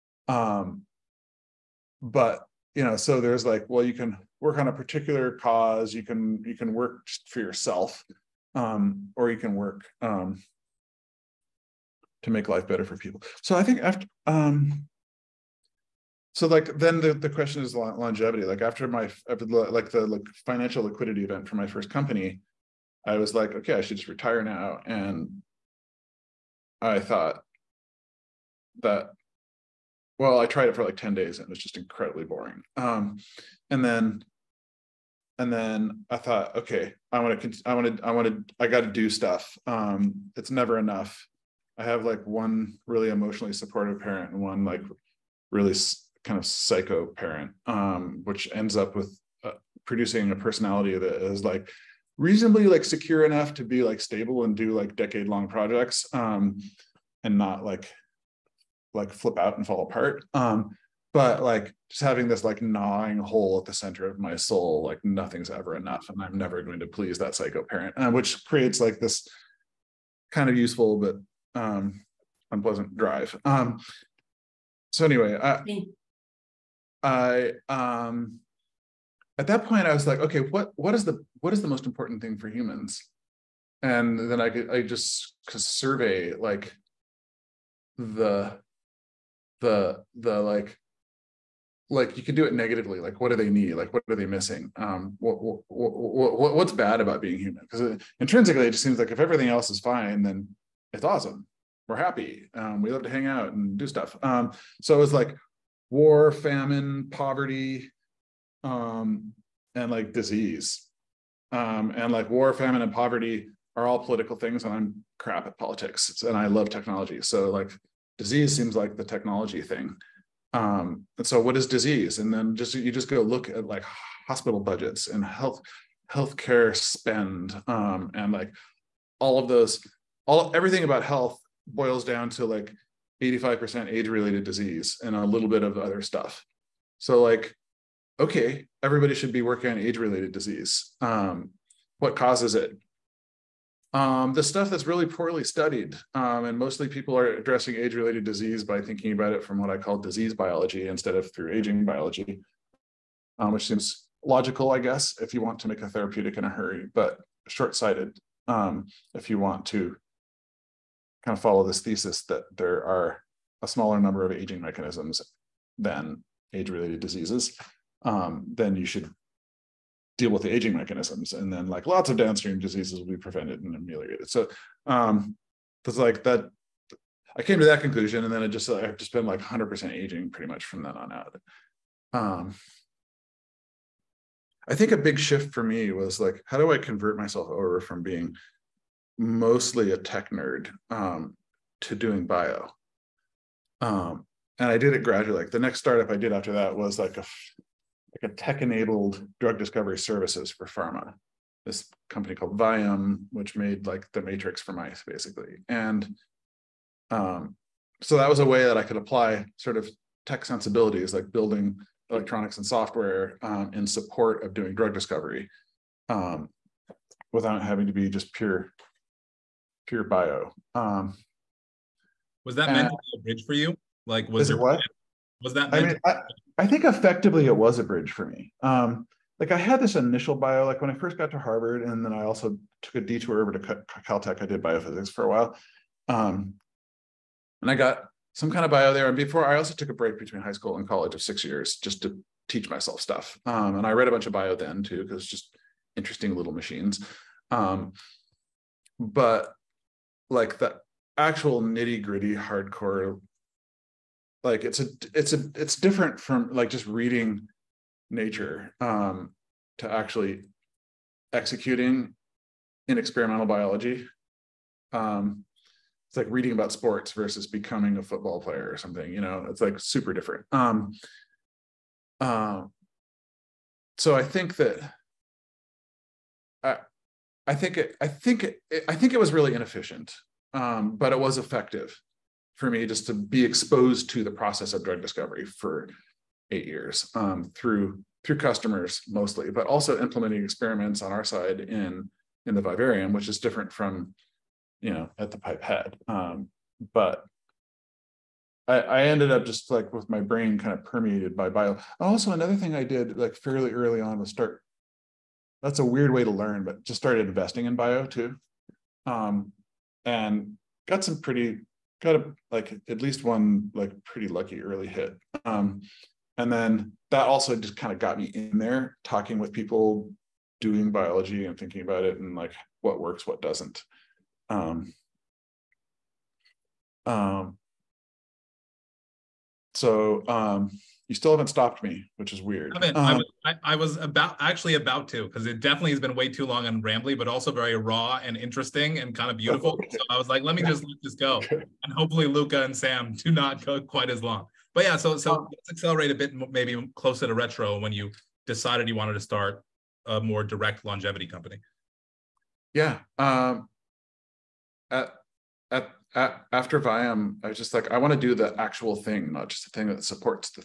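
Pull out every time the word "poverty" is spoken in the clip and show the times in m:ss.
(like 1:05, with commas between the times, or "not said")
1:47, 1:52.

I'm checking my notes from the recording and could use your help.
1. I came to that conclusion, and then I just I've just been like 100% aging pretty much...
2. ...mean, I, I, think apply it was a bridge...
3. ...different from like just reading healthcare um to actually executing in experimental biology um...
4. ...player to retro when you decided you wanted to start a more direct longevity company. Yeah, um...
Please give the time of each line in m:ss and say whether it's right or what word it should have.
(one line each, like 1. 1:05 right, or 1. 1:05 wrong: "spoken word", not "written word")
1. 2:57 right
2. 3:45 wrong: "effectively", not "apply"
3. 4:15 wrong: "nature", not "healthcare"
4. 5:46 wrong: "closer", not "player".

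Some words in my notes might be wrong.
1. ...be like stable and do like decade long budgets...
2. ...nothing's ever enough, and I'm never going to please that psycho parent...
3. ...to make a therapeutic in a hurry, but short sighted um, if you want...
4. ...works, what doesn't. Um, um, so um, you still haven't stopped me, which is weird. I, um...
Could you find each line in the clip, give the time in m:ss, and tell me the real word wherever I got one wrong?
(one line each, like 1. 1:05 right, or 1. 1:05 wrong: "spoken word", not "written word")
1. 0:53 wrong: "projects", not "budgets"
2. 1:05 right
3. 2:35 right
4. 5:22 right.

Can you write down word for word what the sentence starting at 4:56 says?
Um, but I, I ended up just like with my brain kind of permeated by bio.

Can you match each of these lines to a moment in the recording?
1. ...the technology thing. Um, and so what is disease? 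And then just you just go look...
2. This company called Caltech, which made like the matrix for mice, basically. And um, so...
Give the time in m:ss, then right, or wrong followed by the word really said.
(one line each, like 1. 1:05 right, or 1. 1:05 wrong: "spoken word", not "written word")
1. 1:58 right
2. 3:21 wrong: "Vium", not "Caltech".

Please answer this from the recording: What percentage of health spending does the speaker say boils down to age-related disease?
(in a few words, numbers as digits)
85%.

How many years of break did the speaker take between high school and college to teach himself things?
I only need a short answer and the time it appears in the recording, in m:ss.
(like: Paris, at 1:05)
6, at 4:01.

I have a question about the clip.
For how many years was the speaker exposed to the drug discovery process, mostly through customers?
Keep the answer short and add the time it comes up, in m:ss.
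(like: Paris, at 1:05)
8, at 4:46.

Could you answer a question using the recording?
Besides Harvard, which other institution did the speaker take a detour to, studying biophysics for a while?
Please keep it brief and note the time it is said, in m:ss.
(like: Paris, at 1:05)
Caltech, at 3:54.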